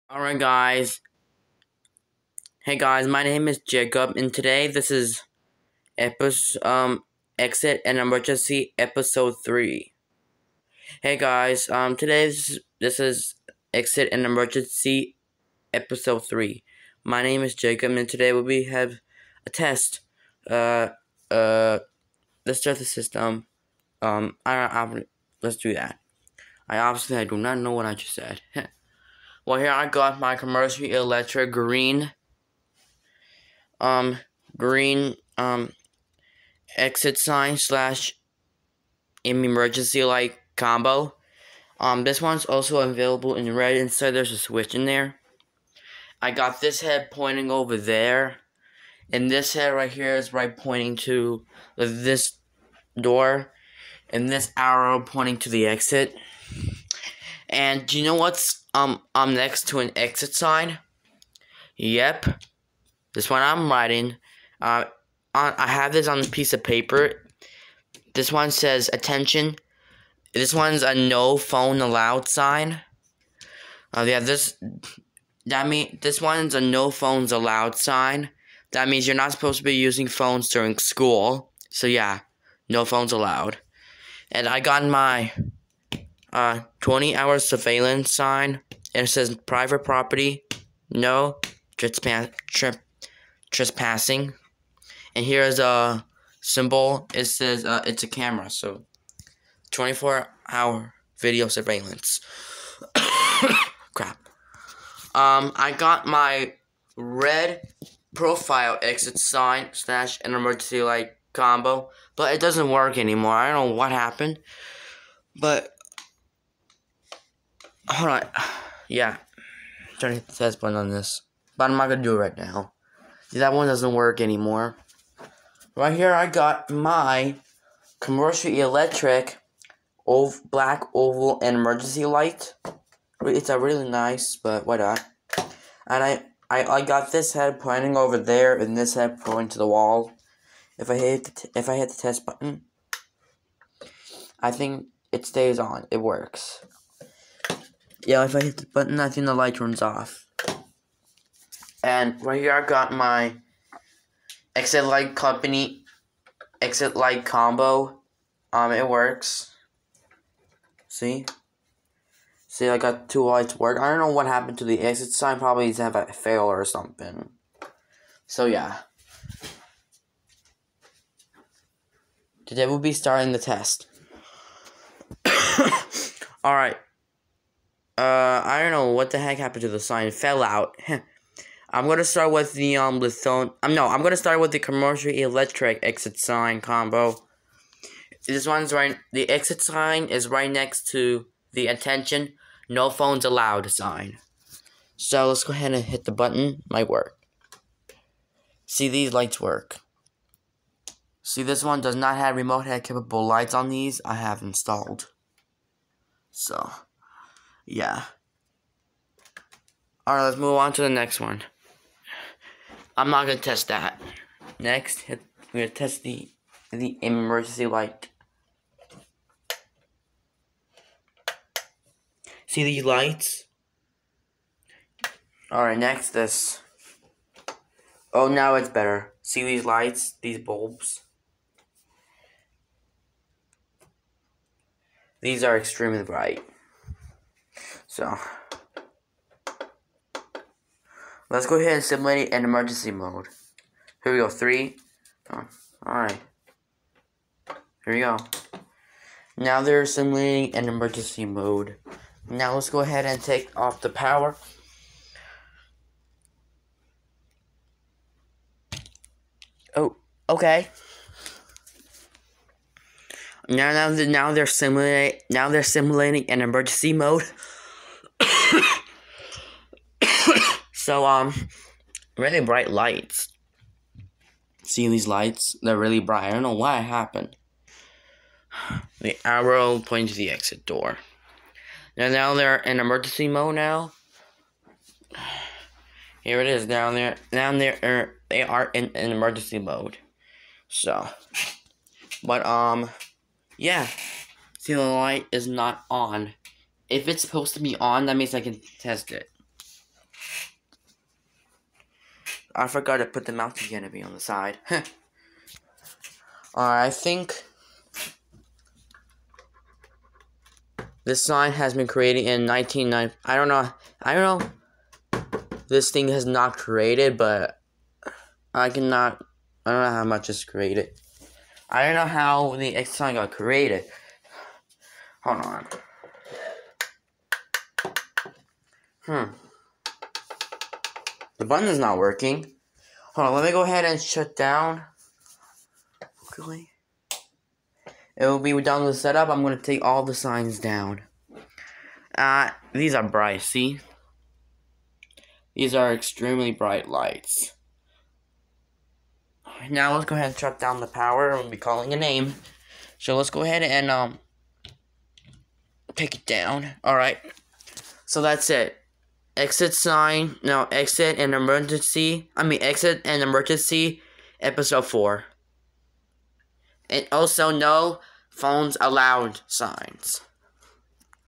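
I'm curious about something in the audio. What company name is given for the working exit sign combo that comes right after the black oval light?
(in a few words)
Exit Light Company.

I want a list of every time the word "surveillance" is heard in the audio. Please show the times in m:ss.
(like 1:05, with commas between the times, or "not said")
1:27, 1:41.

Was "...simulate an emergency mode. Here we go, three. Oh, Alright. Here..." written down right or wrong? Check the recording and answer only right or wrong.
right.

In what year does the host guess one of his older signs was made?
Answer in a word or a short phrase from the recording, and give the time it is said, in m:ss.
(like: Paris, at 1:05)
1990, at 5:12.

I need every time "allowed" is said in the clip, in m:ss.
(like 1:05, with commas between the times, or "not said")
1:11, 1:17, 1:23, 3:13, 6:08.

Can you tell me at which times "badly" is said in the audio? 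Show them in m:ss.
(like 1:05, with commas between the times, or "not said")
not said.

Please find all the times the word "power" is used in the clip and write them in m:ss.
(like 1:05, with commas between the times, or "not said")
4:13, 5:50.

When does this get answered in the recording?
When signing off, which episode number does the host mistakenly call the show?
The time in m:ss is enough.
6:04.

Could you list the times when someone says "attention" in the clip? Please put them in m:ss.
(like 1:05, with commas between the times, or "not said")
1:08, 3:11.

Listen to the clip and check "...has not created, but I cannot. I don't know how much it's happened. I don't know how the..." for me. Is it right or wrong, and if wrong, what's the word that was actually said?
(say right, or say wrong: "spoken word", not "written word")
wrong: "created", not "happened".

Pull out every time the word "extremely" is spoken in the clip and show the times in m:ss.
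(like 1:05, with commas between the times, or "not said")
3:55, 5:45.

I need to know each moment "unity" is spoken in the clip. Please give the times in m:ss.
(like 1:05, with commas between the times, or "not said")
not said.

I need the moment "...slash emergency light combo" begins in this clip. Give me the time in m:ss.
0:37.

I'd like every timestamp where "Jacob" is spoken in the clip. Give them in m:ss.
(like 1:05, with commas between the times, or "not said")
0:03, 0:17.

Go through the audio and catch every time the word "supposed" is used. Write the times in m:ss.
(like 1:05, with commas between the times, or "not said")
1:19, 4:57.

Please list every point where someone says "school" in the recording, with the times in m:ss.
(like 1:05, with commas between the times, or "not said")
1:20.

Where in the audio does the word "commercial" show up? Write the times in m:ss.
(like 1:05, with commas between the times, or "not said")
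0:30, 2:07, 3:04.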